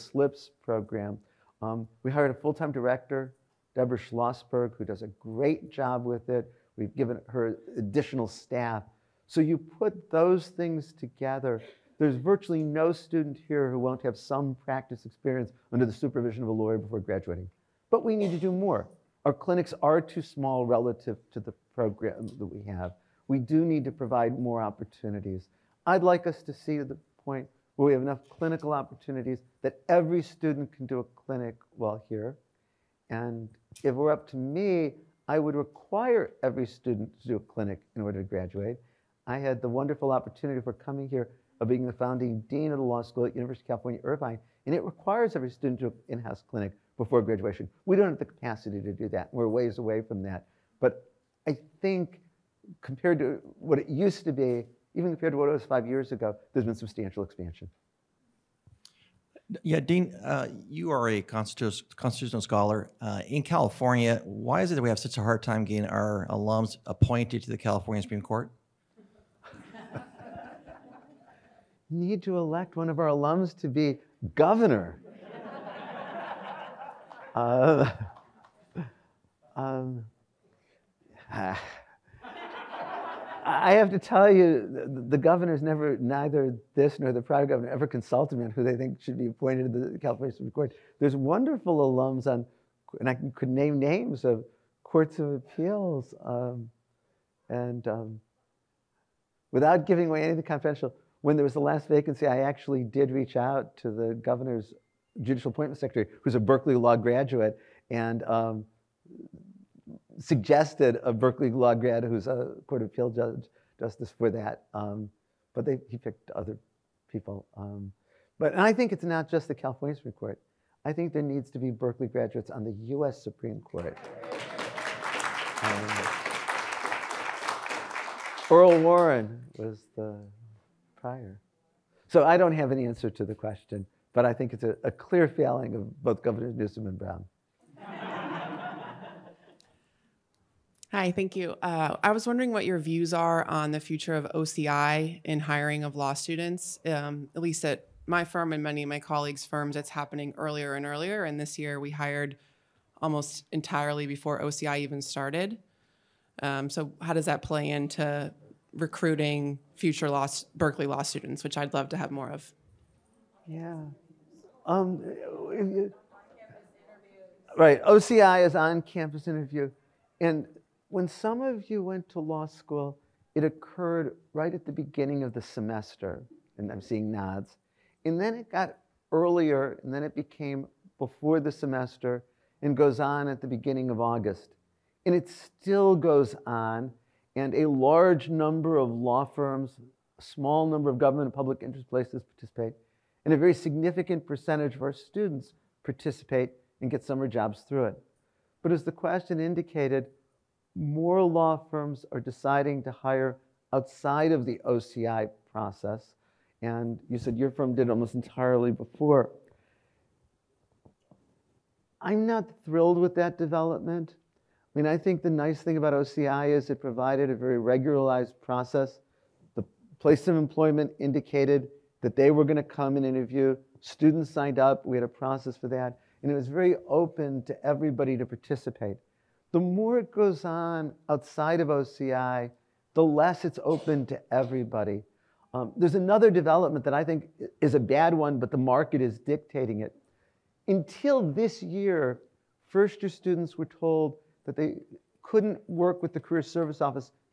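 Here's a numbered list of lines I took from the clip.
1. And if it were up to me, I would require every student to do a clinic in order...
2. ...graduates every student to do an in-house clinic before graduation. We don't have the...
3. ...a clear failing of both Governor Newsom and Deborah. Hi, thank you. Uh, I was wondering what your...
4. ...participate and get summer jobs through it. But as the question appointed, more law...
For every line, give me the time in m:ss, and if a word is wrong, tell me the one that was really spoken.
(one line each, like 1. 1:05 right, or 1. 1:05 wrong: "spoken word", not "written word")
1. 0:33 right
2. 0:44 wrong: "requires", not "graduates"
3. 2:14 wrong: "Brown", not "Deborah"
4. 3:15 wrong: "indicated", not "appointed".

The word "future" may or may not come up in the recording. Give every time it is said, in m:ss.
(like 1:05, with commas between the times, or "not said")
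2:23, 2:39.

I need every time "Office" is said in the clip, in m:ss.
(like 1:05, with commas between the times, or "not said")
4:06.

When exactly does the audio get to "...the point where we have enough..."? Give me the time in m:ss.
0:26.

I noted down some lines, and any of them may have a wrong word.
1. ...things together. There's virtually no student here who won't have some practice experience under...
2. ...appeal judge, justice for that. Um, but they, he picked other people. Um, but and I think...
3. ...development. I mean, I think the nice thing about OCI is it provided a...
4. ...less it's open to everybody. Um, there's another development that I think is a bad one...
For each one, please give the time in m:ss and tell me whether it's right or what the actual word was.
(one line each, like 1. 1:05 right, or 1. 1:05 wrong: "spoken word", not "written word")
1. 0:10 right
2. 1:52 right
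3. 3:33 right
4. 3:53 right.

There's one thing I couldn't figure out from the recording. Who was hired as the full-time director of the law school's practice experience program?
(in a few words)
Deborah Schlossberg.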